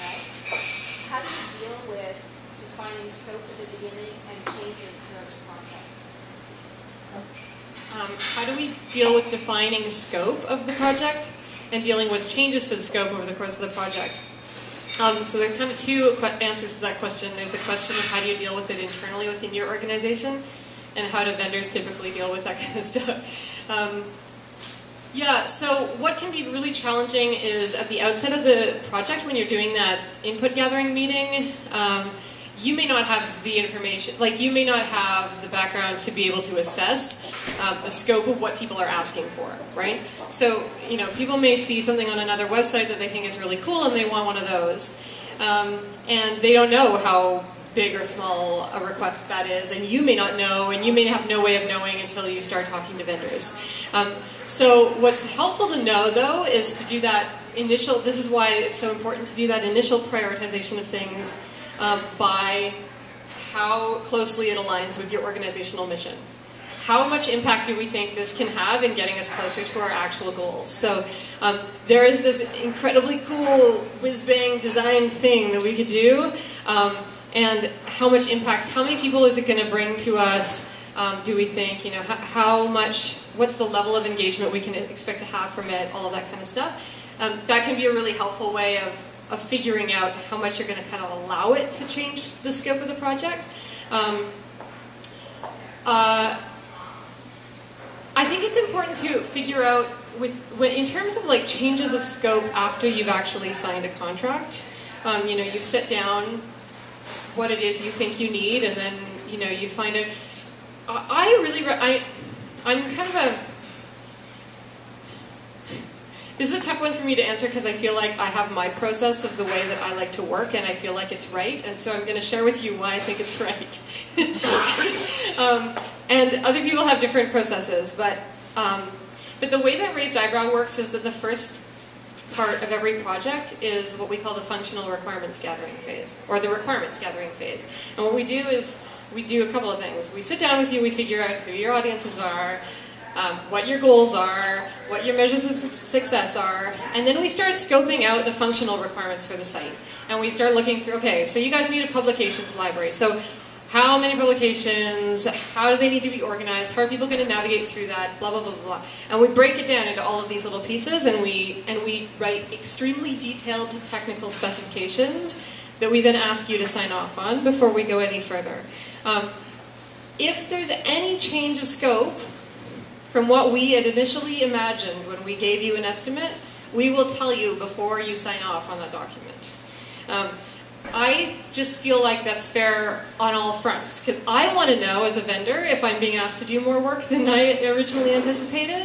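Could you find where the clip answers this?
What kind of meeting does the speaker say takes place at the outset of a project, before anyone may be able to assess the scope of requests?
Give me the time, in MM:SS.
00:30.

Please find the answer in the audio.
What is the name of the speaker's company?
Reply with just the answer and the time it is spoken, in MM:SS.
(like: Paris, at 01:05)
Raised Eyebrow, at 02:09.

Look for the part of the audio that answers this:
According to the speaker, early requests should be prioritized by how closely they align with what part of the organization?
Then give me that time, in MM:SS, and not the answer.
01:05.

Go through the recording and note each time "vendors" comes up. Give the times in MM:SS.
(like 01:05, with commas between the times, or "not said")
00:21, 00:53, 03:05.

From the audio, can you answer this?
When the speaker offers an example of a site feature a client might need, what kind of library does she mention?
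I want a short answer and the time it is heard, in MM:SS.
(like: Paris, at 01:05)
Publications library, at 02:31.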